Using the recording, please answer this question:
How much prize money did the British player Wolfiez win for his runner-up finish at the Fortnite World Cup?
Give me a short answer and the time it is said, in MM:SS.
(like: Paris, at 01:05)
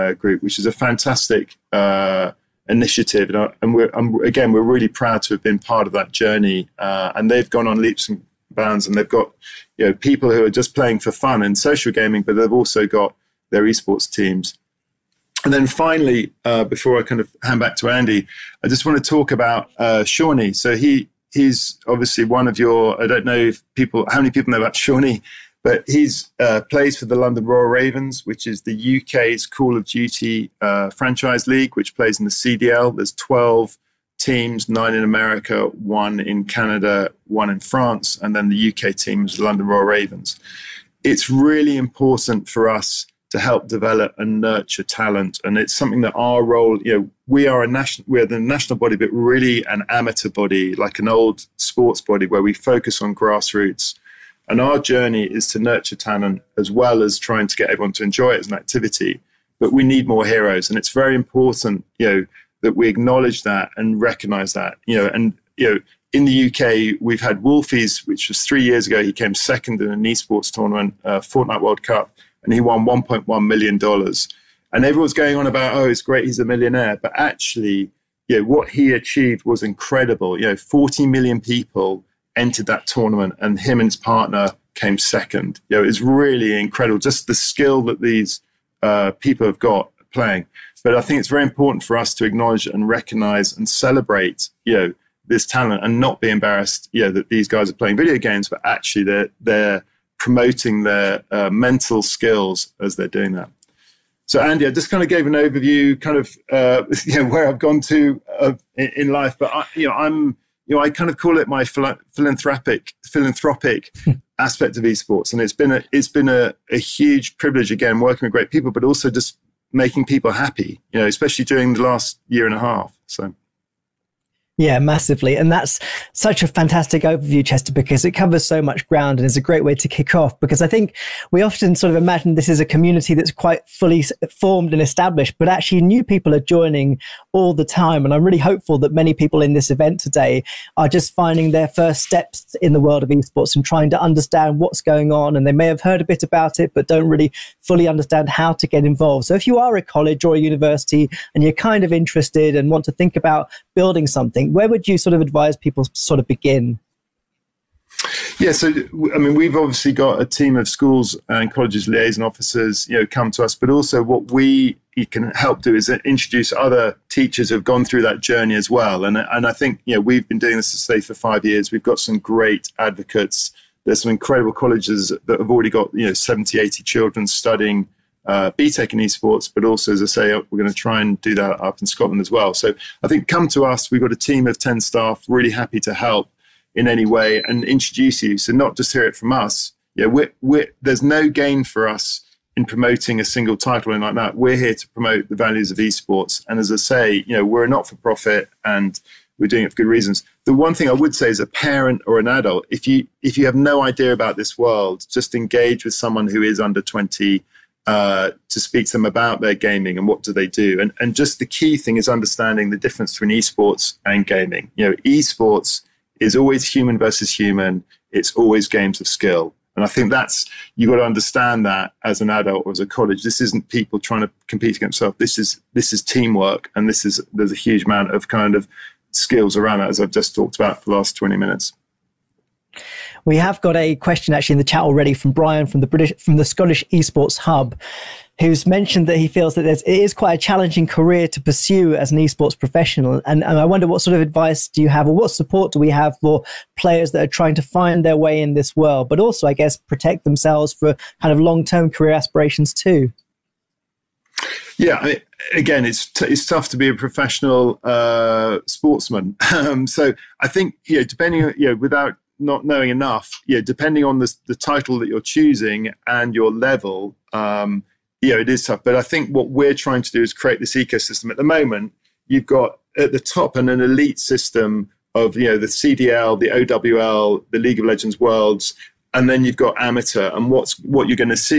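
1.1 million dollars, at 01:12.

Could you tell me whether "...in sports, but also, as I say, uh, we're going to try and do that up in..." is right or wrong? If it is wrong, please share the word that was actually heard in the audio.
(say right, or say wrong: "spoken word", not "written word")
wrong: "esports", not "sports".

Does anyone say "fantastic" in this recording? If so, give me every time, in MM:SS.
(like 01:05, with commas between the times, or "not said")
00:00, 02:06.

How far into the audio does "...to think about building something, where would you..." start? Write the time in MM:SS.
02:32.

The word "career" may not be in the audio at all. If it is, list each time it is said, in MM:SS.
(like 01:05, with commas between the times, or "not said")
04:00, 04:11.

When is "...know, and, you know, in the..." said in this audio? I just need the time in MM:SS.
01:04.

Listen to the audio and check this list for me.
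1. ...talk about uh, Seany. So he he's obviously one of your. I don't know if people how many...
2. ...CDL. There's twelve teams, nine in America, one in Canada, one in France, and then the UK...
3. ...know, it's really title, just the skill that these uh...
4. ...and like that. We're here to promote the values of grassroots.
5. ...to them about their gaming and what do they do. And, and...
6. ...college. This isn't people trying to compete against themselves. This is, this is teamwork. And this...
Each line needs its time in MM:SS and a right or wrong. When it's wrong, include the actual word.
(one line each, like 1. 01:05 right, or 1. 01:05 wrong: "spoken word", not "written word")
1. 00:19 right
2. 00:32 right
3. 01:25 wrong: "incredible", not "title"
4. 03:13 wrong: "esports", not "grassroots"
5. 03:28 right
6. 03:42 right.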